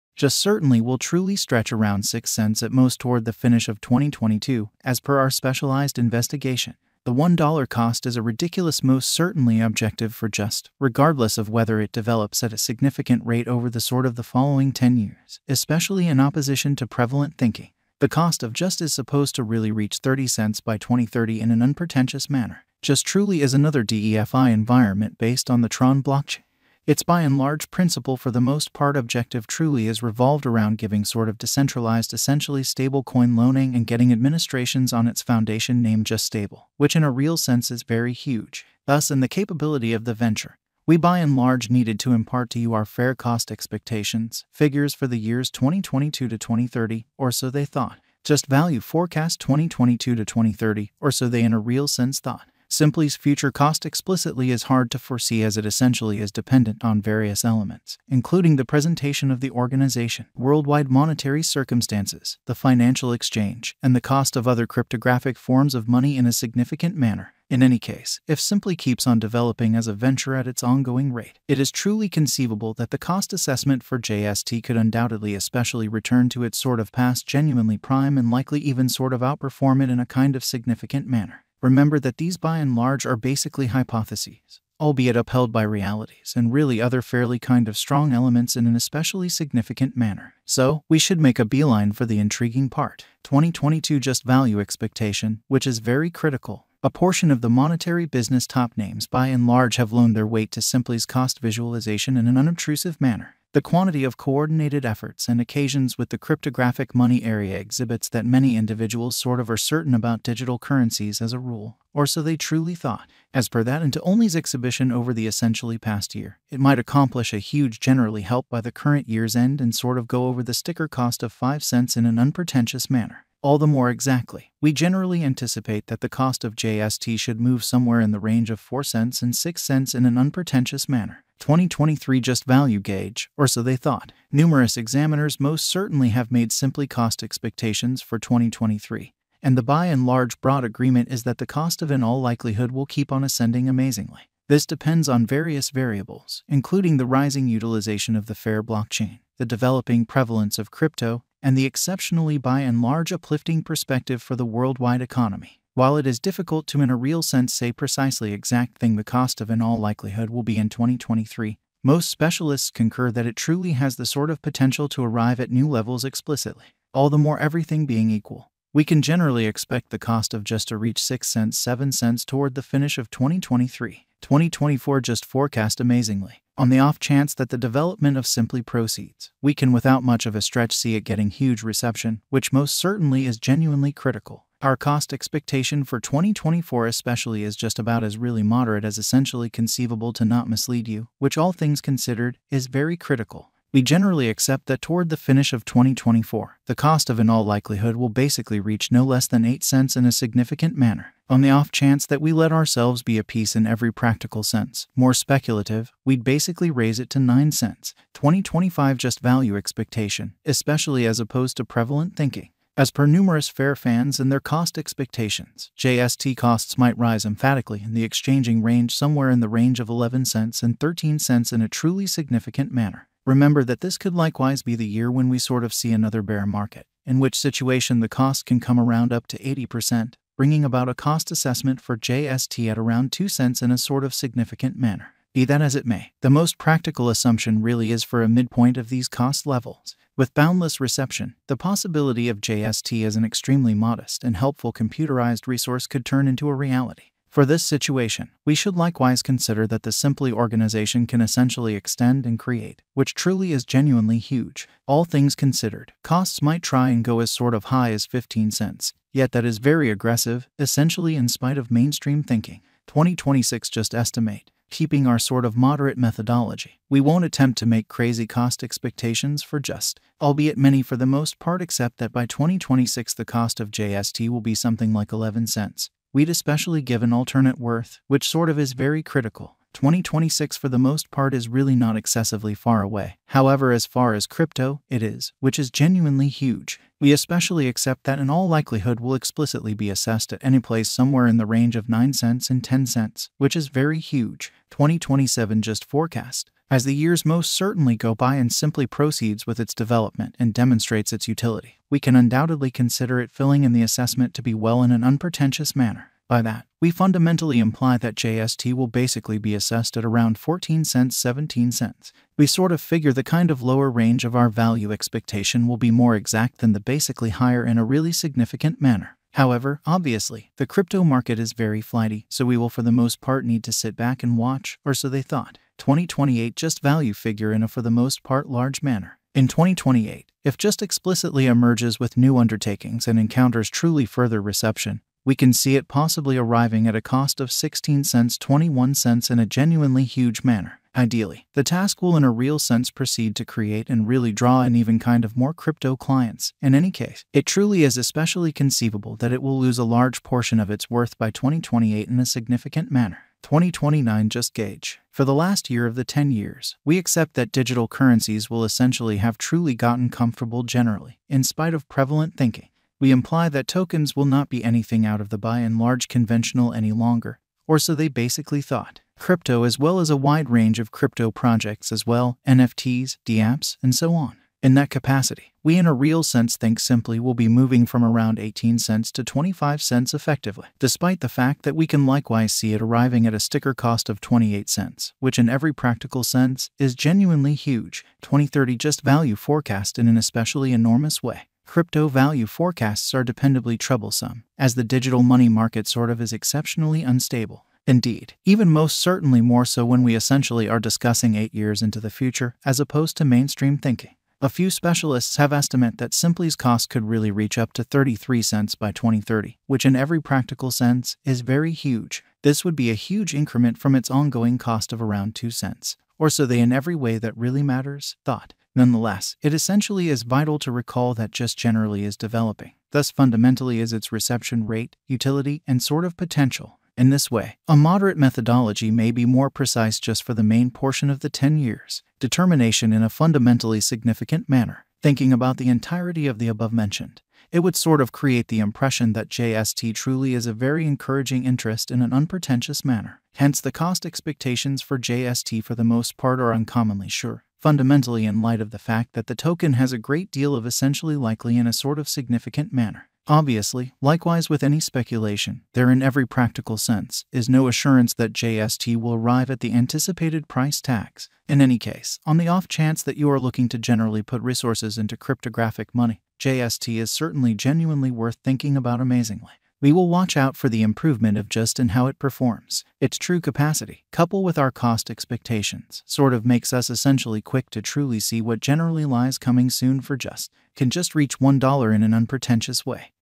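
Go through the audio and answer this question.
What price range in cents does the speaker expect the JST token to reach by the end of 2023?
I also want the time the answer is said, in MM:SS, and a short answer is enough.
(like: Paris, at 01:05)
6 to 7 cents, at 02:51.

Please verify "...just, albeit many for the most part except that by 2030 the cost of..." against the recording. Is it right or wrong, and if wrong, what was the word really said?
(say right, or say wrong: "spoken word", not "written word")
wrong: "2026", not "2030".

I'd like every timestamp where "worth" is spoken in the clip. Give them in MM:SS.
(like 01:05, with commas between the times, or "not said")
04:37, 05:50, 07:48.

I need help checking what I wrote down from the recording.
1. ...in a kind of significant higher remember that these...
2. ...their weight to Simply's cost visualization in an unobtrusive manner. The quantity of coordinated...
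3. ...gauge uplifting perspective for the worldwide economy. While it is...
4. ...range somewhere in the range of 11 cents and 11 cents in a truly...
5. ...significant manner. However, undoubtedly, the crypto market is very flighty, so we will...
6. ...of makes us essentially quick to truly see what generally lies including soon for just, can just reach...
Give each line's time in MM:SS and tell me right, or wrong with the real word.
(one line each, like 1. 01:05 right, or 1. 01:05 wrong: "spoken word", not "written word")
1. 01:19 wrong: "manner", not "higher"
2. 01:40 right
3. 02:32 wrong: "large", not "gauge"
4. 03:38 wrong: "13", not "11"
5. 05:18 wrong: "obviously", not "undoubtedly"
6. 07:56 wrong: "coming", not "including".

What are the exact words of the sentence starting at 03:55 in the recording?
Be that as it may, the most practical assumption really is for a midpoint of these cost levels.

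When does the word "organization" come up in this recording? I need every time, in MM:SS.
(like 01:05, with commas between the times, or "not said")
00:59, 04:10.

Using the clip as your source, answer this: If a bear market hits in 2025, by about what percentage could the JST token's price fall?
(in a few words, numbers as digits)
80%.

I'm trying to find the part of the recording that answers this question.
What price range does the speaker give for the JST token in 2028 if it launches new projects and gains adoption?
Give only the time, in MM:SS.
05:37.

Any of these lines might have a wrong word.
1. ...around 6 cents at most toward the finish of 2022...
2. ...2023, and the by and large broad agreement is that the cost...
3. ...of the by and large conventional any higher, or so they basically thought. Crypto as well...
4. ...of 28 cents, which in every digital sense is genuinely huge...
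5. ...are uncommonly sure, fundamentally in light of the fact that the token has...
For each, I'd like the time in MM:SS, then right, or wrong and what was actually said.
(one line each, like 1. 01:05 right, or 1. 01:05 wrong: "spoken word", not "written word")
1. 00:01 right
2. 02:18 right
3. 06:05 wrong: "longer", not "higher"
4. 06:24 wrong: "practical", not "digital"
5. 07:26 right.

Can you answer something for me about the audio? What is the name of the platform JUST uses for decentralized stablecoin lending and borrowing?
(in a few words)
Just Stable.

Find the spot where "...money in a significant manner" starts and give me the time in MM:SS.
01:05.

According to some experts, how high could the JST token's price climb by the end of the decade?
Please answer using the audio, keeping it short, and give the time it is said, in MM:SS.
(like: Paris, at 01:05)
33 cents, at 06:47.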